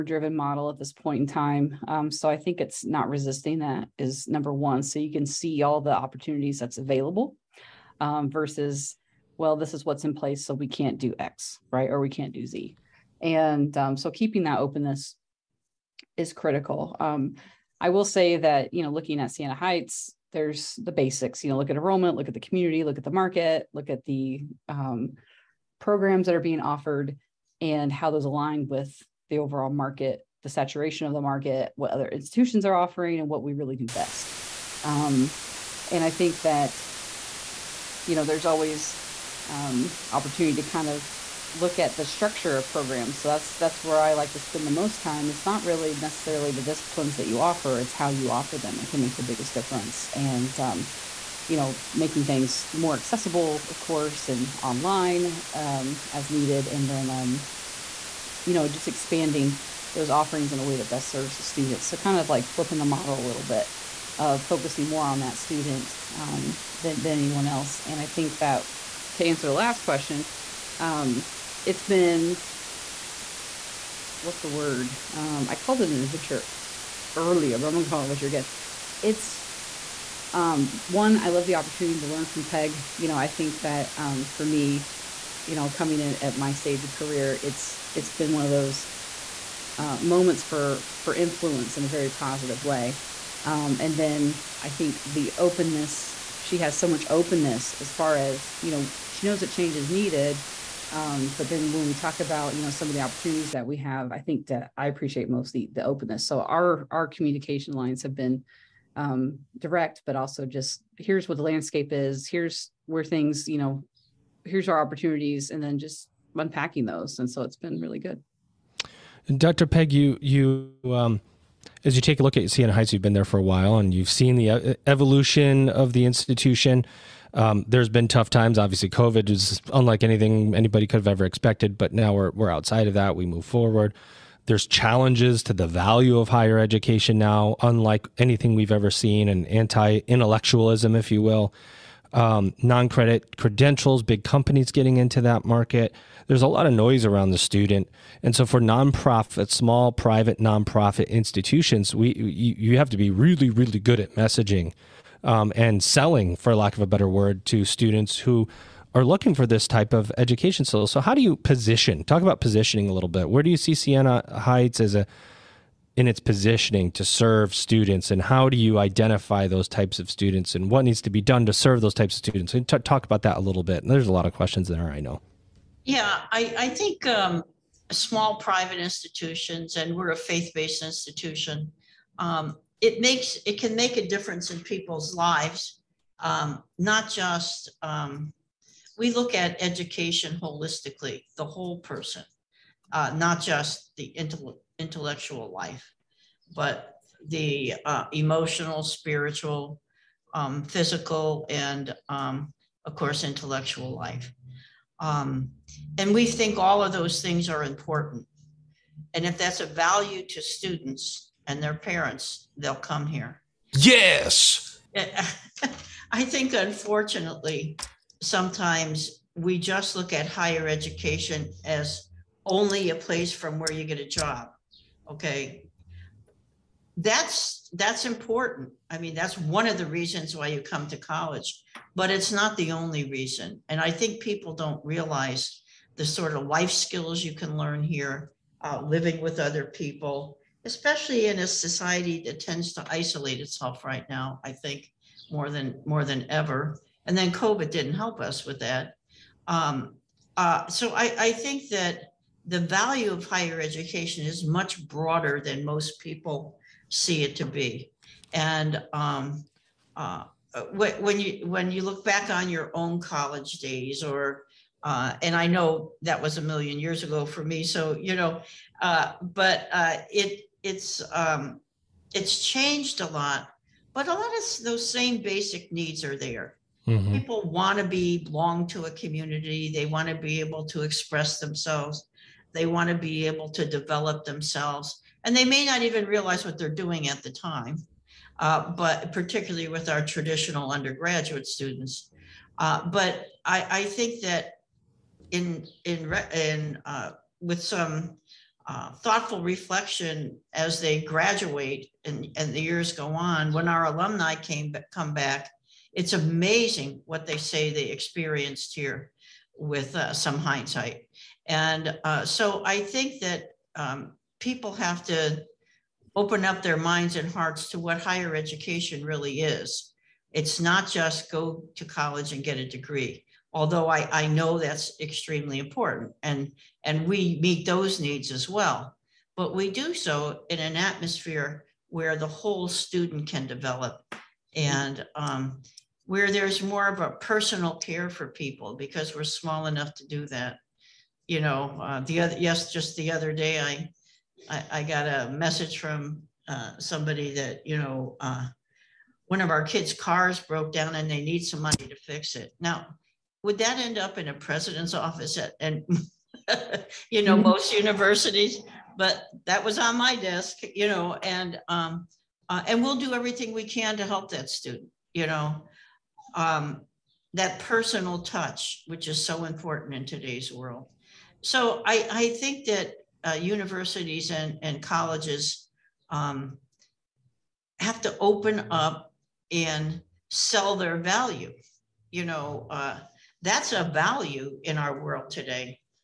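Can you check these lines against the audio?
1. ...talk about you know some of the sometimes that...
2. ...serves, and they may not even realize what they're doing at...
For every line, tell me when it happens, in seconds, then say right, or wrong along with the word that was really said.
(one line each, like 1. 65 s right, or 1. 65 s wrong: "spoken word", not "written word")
1. 101 s wrong: "opportunities", not "sometimes"
2. 284 s wrong: "themselves", not "serves".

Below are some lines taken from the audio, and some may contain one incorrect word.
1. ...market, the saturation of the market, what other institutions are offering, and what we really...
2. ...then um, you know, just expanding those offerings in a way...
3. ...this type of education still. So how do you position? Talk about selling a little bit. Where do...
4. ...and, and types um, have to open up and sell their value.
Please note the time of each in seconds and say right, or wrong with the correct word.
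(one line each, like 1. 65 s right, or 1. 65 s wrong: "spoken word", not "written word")
1. 29 s right
2. 56 s right
3. 159 s wrong: "positioning", not "selling"
4. 374 s wrong: "colleges", not "types".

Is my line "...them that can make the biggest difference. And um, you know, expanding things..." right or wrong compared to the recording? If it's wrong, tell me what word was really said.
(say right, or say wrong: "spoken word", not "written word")
wrong: "making", not "expanding".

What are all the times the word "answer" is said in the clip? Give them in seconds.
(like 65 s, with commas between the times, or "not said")
69 s.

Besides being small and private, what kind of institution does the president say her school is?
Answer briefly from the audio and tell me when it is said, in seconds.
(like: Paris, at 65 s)
faith-based, at 180 s.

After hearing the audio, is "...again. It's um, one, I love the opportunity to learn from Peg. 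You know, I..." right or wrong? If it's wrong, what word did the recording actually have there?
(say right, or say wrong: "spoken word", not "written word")
right.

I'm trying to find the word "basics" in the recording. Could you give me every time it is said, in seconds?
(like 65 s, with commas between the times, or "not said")
20 s, 275 s.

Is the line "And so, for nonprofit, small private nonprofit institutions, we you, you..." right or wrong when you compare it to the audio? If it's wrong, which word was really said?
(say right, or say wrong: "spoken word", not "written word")
right.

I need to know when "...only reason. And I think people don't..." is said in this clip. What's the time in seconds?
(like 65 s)
232 s.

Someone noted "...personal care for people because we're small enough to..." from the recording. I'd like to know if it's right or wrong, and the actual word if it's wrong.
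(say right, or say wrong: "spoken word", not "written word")
right.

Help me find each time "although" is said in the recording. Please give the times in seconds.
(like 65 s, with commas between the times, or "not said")
323 s.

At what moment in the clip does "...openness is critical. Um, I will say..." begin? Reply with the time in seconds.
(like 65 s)
14 s.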